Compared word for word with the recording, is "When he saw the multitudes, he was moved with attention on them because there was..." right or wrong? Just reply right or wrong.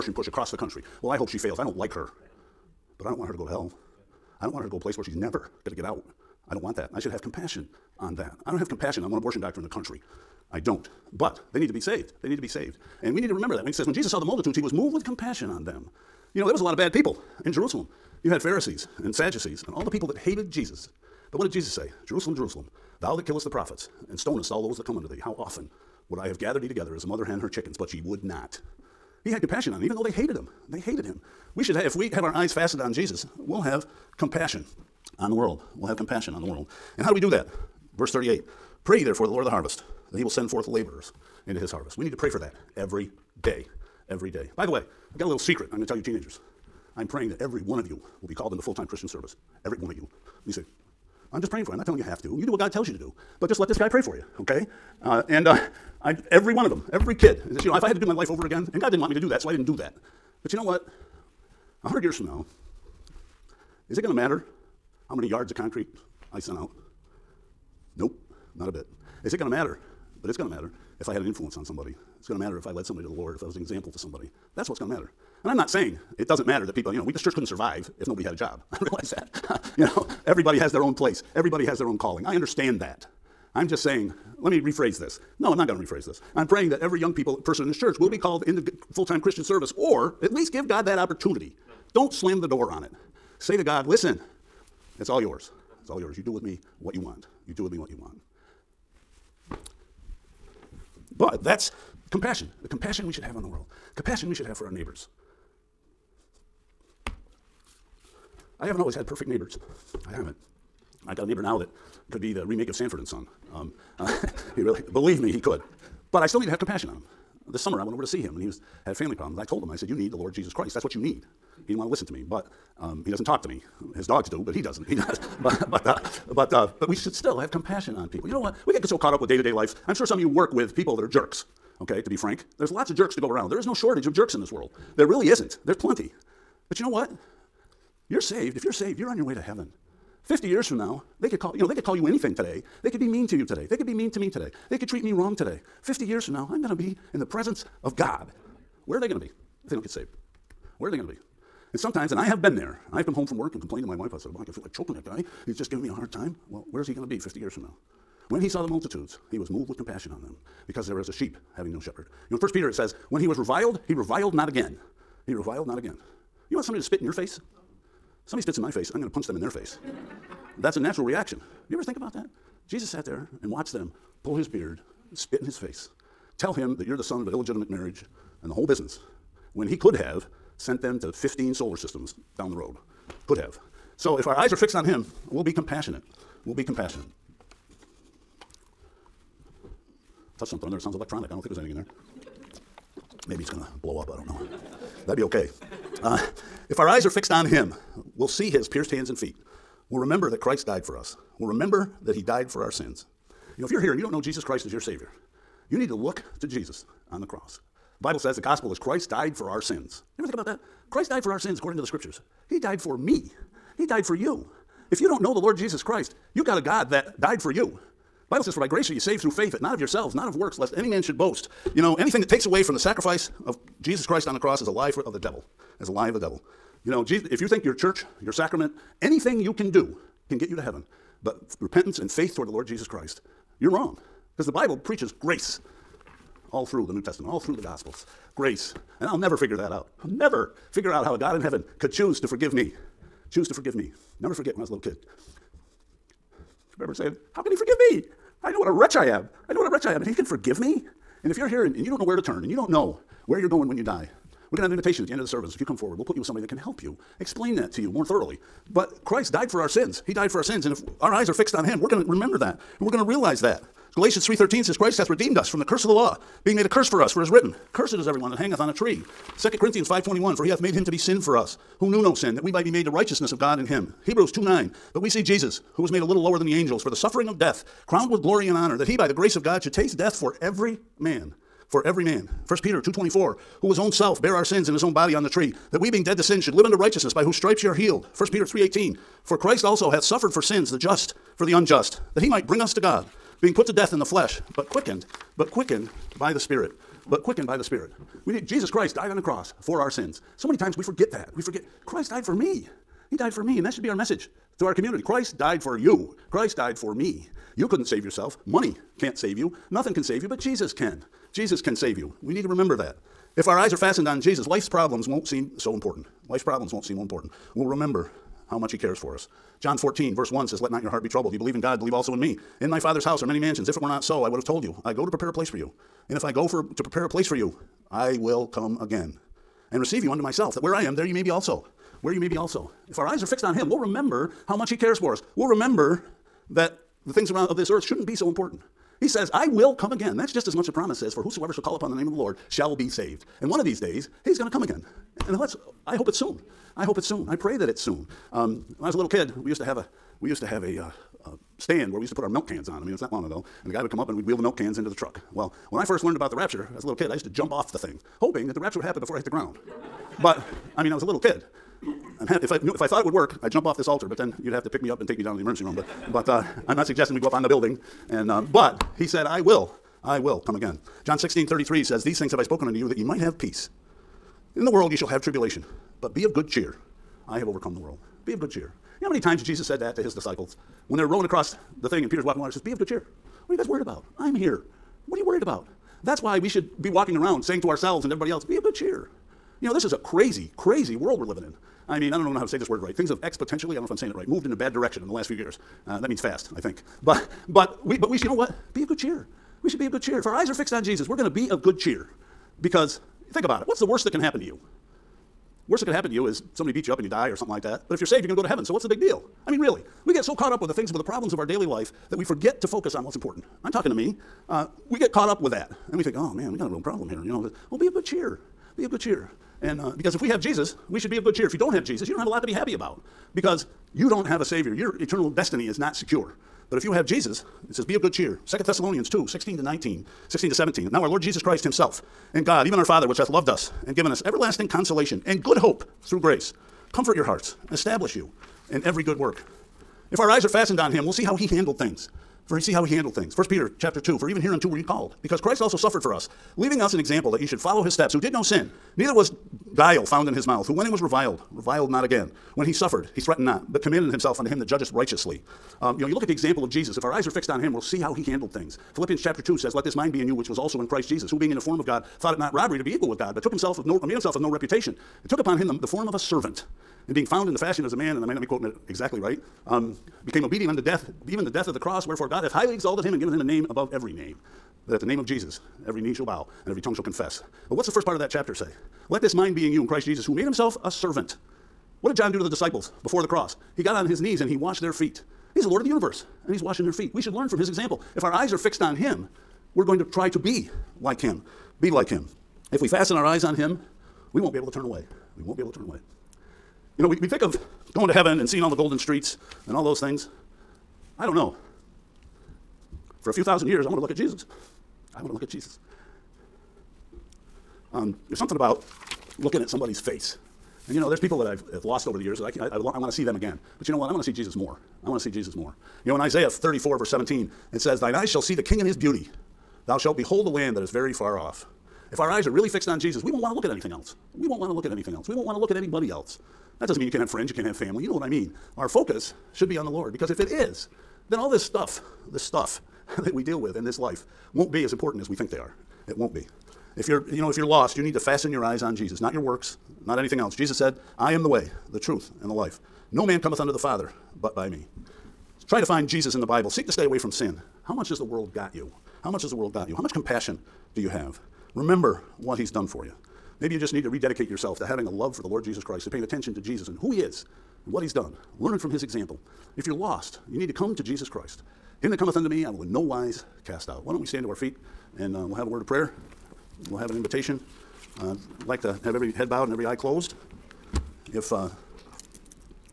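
wrong.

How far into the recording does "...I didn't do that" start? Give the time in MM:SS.
00:59.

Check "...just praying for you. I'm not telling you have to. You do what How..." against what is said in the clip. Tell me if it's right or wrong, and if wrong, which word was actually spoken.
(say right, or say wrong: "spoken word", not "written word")
wrong: "God", not "How".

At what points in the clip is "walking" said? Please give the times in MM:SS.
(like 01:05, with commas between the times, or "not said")
06:22, 06:26.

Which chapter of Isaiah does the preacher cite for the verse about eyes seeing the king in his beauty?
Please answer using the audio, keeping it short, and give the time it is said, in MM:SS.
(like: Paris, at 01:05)
34, at 08:36.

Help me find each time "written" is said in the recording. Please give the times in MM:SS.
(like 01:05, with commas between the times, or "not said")
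04:27.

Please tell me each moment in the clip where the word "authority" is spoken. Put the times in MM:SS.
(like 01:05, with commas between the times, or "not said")
not said.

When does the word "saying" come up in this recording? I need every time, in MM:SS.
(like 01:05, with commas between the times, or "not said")
01:15, 01:23, 04:06, 06:27, 06:33.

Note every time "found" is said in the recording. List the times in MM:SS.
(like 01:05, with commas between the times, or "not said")
07:30, 07:47.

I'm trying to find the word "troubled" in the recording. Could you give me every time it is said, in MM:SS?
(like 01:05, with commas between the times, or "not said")
05:21.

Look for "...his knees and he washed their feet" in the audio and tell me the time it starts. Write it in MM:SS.
08:04.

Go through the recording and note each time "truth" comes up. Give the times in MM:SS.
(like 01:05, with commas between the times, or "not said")
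09:01.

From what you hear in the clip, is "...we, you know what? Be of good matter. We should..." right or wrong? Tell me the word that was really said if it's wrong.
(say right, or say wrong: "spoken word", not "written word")
wrong: "cheer", not "matter".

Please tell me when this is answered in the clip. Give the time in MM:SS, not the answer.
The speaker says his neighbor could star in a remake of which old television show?
01:52.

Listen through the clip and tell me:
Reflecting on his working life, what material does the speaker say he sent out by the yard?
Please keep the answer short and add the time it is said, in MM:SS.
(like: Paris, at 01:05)
Concrete, at 01:05.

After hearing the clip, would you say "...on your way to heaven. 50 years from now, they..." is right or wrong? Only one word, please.
right.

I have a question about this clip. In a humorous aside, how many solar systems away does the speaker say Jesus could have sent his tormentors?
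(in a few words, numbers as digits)
15.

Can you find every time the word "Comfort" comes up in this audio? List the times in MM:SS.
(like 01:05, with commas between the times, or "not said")
07:16.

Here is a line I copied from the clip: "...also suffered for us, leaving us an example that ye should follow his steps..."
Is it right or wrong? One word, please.
right.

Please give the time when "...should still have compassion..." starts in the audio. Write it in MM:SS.
02:06.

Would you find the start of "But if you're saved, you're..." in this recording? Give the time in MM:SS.
06:47.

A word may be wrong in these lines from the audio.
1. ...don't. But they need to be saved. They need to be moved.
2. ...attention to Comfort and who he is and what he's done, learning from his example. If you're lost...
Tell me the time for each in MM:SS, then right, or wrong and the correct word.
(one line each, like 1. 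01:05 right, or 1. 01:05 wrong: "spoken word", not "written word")
1. 00:10 wrong: "saved", not "moved"
2. 09:16 wrong: "Jesus", not "Comfort".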